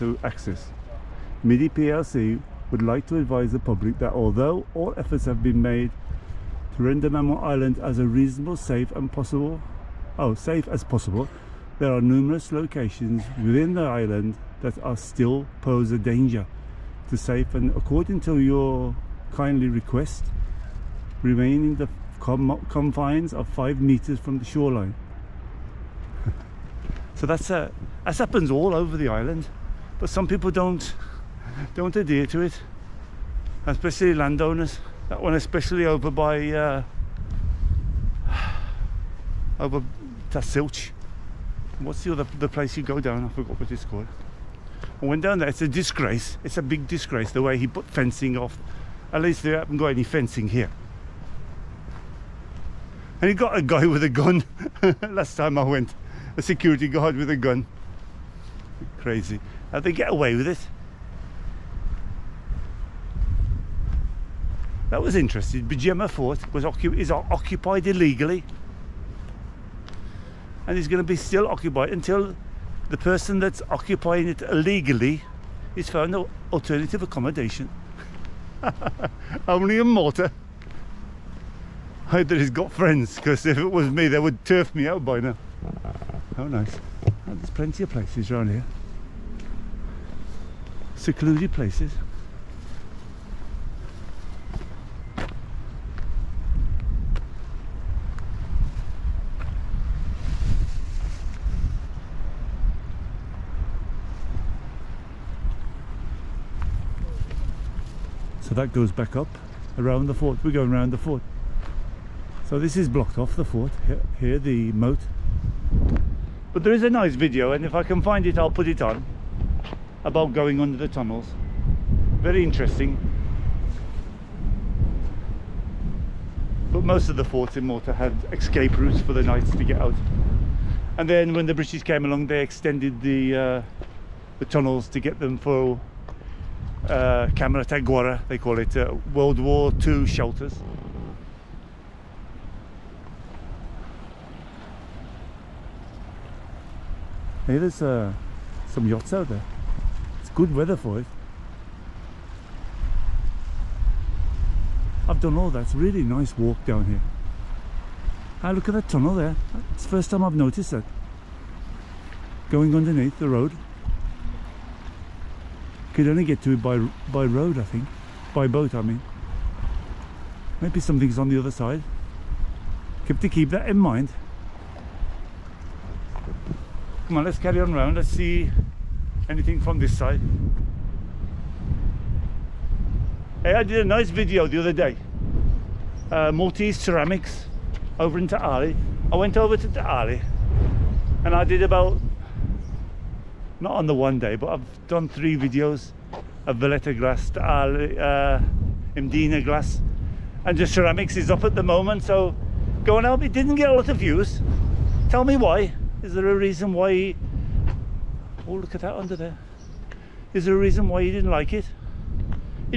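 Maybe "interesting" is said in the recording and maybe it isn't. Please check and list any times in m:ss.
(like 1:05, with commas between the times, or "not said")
1:05, 2:02.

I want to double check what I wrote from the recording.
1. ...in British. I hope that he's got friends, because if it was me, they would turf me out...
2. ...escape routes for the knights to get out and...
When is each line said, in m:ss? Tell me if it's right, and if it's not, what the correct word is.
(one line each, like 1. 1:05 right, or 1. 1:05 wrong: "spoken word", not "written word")
1. 1:19 wrong: "Malta", not "British"
2. 2:08 right.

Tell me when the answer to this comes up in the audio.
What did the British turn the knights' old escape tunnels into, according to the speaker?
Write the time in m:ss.
2:19.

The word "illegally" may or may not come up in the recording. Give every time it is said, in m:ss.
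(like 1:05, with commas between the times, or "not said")
1:07, 1:14.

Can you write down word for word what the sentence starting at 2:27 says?
Hey, there's uh, some yachts out there.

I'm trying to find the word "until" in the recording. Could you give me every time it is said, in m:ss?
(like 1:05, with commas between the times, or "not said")
1:11.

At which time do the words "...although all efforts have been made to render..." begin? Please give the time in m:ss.
0:04.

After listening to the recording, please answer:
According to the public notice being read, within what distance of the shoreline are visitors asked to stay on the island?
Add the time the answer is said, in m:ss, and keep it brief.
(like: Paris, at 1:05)
5 meters, at 0:23.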